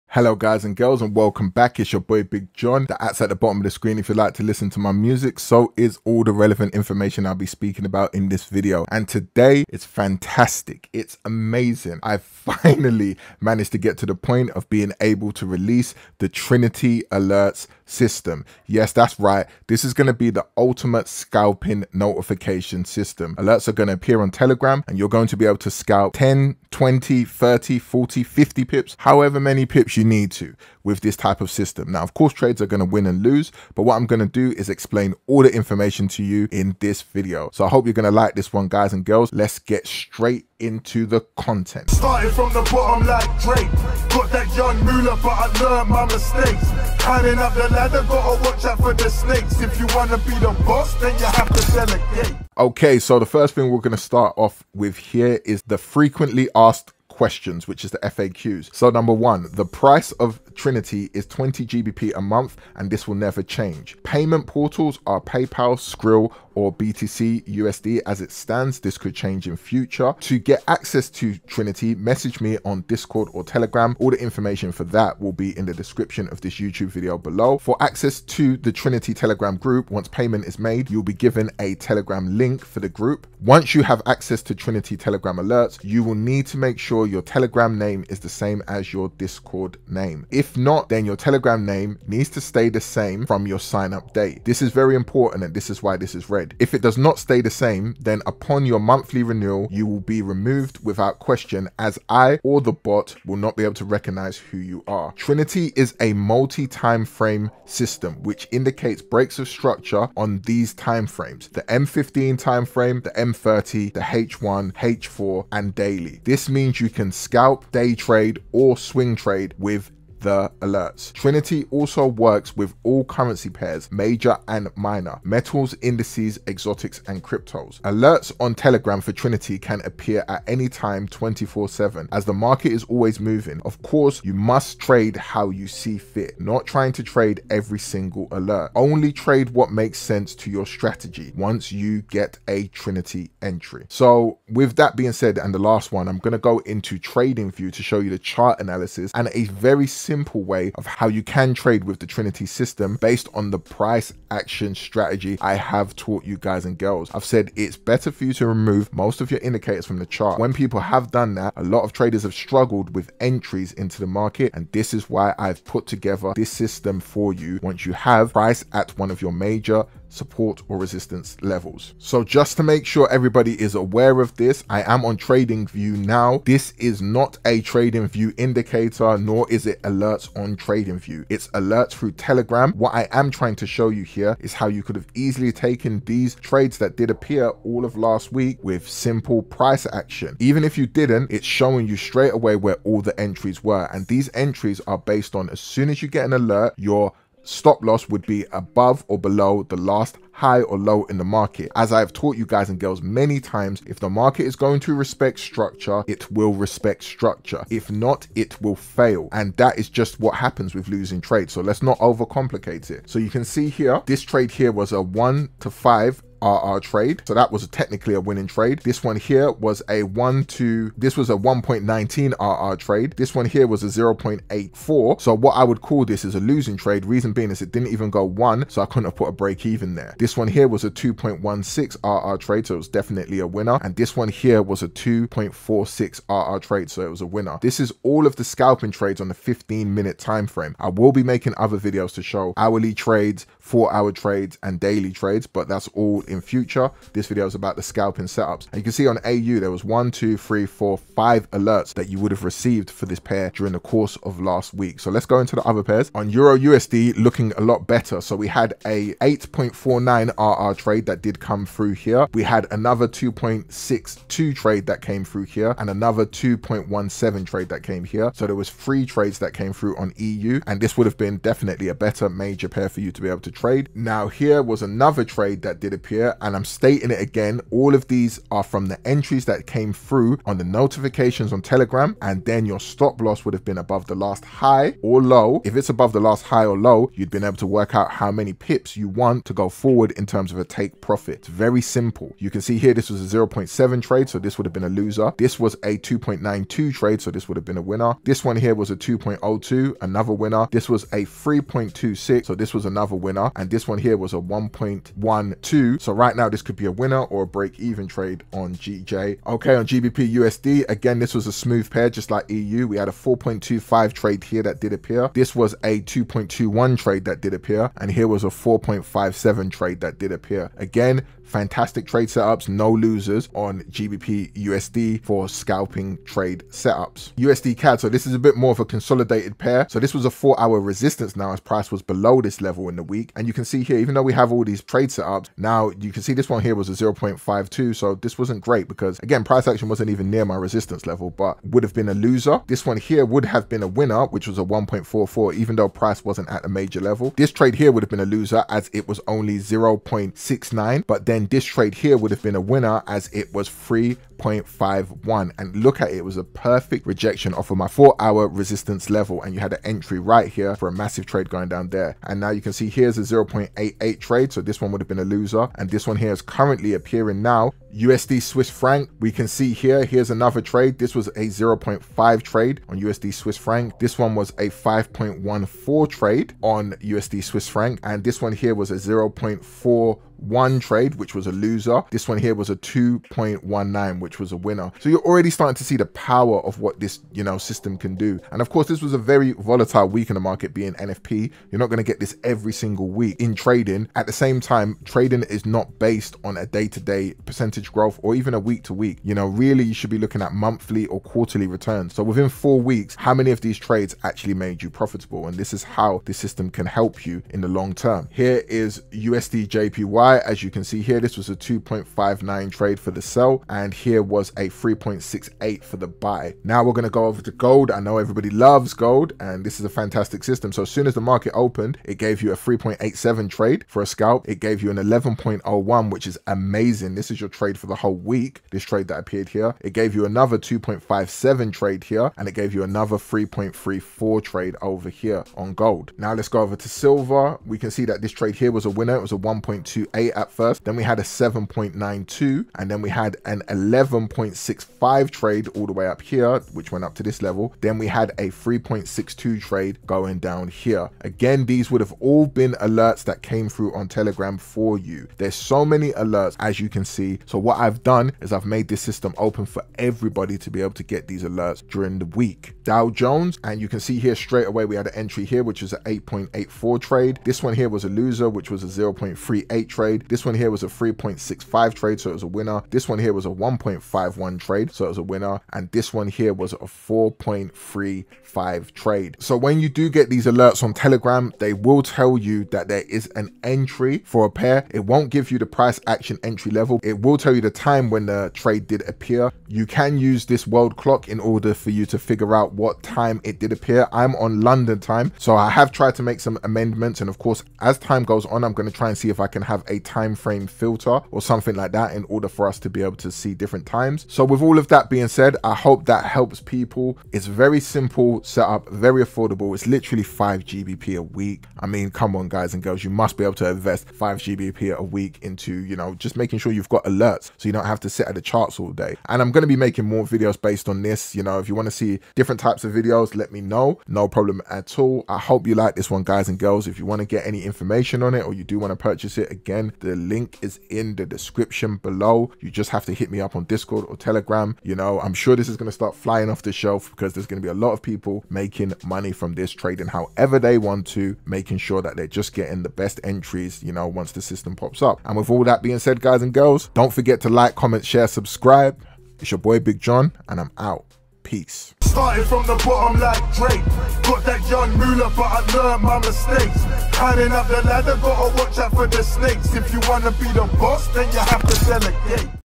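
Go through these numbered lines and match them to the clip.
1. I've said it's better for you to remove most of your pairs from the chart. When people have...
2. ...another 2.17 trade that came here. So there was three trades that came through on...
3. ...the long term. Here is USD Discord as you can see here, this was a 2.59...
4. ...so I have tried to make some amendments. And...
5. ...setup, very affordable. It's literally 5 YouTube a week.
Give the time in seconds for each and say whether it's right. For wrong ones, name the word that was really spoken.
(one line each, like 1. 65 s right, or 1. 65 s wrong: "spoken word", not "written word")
1. 157 s wrong: "indicators", not "pairs"
2. 265 s right
3. 407 s wrong: "JPY", not "Discord"
4. 495 s right
5. 508 s wrong: "GBP", not "YouTube".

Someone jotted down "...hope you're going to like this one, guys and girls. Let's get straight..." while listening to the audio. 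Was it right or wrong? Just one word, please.
right.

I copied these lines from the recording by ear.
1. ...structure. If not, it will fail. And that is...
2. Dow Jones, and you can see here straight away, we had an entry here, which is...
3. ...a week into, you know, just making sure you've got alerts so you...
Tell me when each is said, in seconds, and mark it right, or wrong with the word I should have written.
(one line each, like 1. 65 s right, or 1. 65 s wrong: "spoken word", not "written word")
1. 207 s right
2. 462 s right
3. 514 s right.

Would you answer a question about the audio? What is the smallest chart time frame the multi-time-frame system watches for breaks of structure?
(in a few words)
M15.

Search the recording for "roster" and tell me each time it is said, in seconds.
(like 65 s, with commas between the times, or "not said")
not said.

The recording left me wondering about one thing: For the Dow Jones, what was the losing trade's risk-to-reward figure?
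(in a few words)
0.38.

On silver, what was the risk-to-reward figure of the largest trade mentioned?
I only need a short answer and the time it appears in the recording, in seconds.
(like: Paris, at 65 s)
11.65, at 443 s.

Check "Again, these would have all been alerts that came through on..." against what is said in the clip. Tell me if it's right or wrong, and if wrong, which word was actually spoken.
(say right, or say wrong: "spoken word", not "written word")
right.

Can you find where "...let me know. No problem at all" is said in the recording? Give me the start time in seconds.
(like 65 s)
523 s.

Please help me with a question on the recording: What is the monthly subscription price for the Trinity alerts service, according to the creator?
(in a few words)
20 GBP.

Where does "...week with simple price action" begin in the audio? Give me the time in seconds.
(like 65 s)
188 s.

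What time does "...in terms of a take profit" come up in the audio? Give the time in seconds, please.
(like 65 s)
290 s.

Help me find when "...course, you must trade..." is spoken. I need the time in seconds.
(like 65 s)
133 s.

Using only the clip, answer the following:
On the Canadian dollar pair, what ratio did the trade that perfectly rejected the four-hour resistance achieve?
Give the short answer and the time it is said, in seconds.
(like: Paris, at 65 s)
3.51, at 353 s.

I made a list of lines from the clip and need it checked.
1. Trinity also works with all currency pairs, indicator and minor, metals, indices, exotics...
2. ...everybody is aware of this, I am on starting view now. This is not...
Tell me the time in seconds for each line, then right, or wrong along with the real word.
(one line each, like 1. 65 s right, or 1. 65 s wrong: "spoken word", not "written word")
1. 121 s wrong: "major", not "indicator"
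2. 173 s wrong: "trading", not "starting".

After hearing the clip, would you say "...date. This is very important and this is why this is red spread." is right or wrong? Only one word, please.
right.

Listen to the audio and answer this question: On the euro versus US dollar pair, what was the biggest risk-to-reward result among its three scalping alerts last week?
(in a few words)
8.49.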